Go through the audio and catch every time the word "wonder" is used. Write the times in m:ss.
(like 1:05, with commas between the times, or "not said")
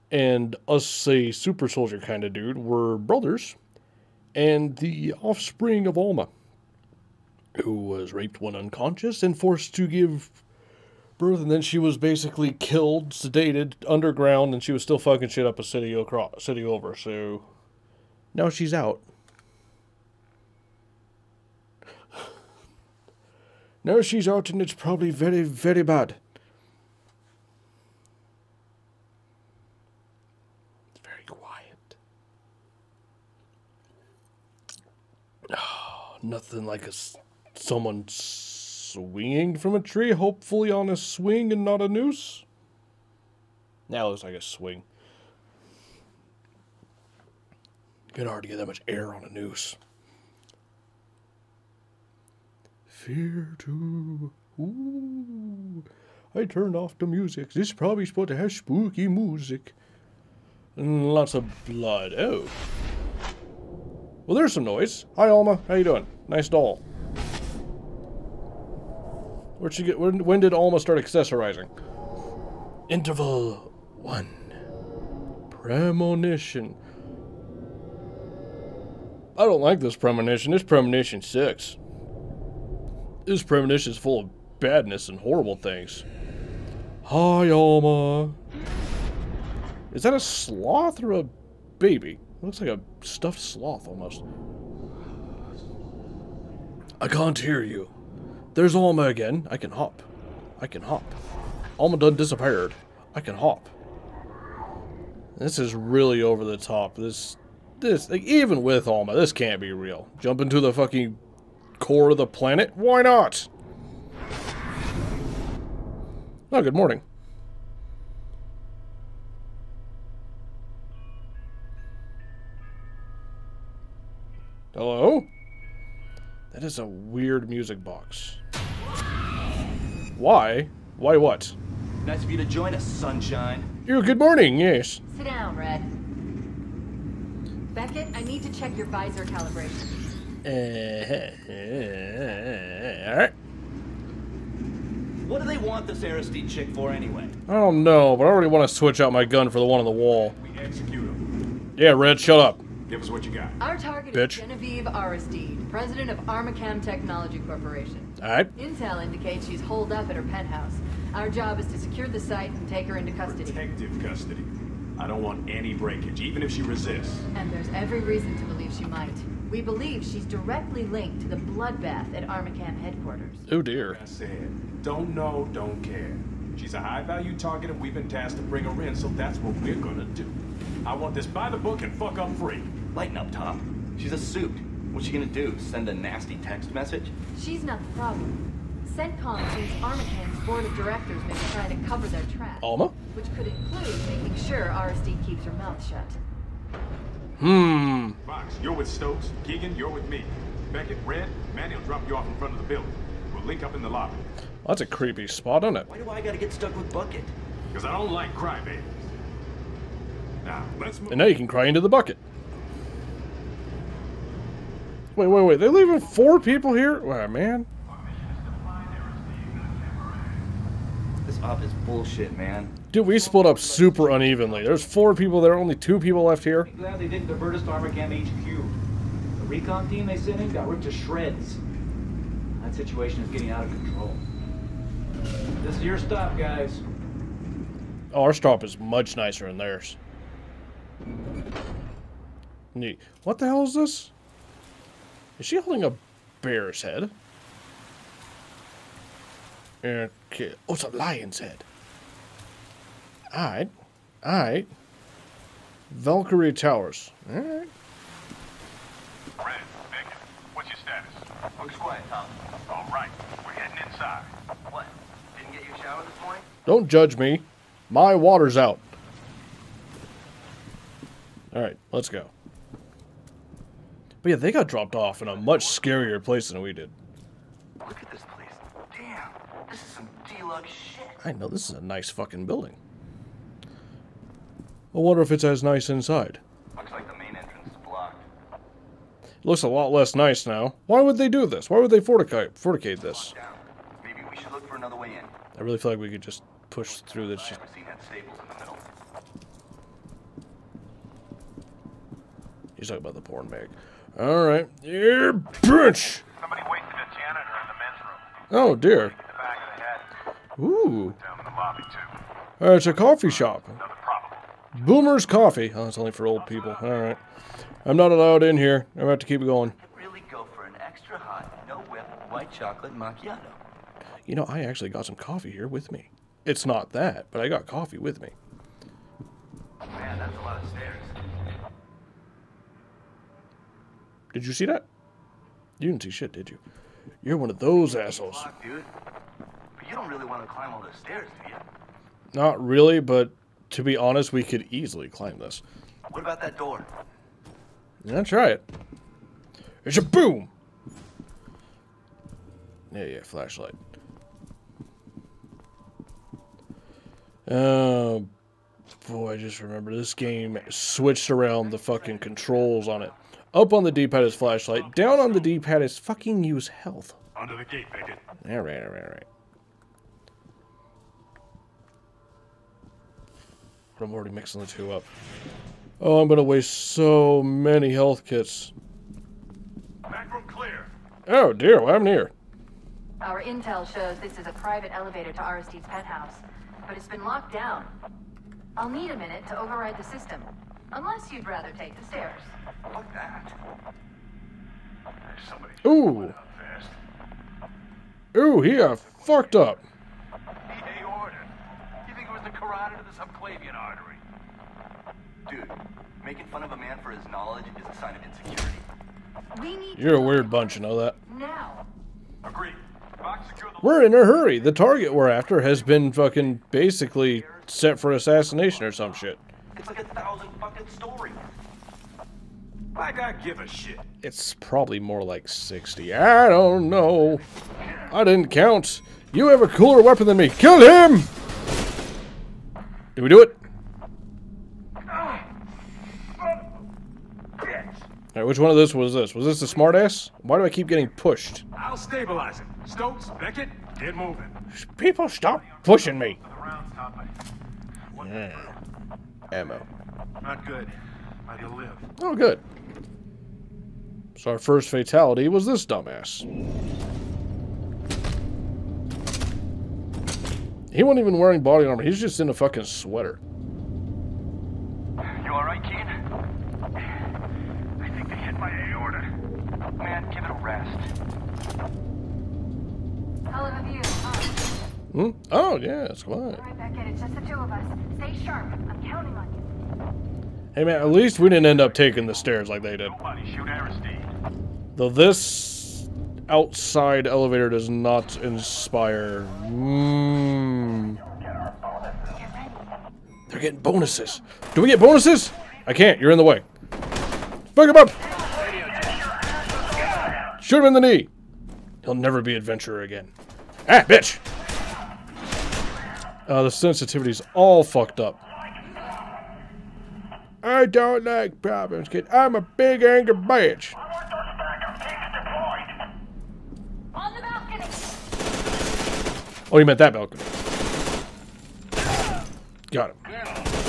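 4:44.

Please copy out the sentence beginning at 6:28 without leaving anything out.
I'll need a minute to override the system, unless you'd rather take the stairs.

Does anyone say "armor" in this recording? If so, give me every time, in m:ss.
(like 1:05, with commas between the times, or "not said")
7:41.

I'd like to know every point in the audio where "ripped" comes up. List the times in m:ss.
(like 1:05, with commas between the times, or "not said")
3:50.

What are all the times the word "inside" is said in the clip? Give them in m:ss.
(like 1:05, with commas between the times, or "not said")
4:23, 4:45.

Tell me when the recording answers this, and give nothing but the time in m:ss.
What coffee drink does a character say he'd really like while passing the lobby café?
5:22.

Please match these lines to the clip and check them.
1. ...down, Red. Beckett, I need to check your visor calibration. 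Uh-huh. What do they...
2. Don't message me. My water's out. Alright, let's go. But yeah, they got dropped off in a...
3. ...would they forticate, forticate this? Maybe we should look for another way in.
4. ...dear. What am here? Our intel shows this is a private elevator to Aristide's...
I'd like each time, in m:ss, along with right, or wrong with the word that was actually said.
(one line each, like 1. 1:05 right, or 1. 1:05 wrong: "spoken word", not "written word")
1. 2:15 right
2. 4:26 wrong: "judge", not "message"
3. 4:51 right
4. 6:21 right.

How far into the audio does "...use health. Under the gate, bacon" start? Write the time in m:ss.
6:06.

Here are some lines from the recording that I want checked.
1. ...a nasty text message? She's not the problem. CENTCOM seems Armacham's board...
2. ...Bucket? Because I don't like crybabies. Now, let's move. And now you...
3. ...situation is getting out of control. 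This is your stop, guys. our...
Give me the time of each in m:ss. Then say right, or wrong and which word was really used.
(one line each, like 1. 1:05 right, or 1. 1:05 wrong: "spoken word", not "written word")
1. 3:05 right
2. 3:26 right
3. 3:52 right.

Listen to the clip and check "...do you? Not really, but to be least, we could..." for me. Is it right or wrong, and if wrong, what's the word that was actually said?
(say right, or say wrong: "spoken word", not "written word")
wrong: "honest", not "least".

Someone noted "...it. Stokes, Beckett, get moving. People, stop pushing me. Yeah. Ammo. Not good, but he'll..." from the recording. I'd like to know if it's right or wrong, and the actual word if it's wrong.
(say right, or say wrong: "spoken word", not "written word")
right.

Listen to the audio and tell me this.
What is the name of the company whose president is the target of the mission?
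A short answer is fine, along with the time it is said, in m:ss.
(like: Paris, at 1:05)
Armacham Technology Corporation, at 2:36.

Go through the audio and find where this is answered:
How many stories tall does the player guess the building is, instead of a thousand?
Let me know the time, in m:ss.
7:05.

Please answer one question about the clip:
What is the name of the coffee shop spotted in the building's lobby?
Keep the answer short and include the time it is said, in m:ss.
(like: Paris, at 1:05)
Boomer's Coffee, at 5:14.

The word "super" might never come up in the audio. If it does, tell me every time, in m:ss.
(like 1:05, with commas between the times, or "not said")
0:01, 3:43.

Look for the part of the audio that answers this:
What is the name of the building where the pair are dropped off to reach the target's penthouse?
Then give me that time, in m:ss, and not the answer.
4:15.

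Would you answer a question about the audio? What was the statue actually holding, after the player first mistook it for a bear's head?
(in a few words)
lion's head.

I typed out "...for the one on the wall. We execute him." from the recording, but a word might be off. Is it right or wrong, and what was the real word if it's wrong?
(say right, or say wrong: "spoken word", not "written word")
right.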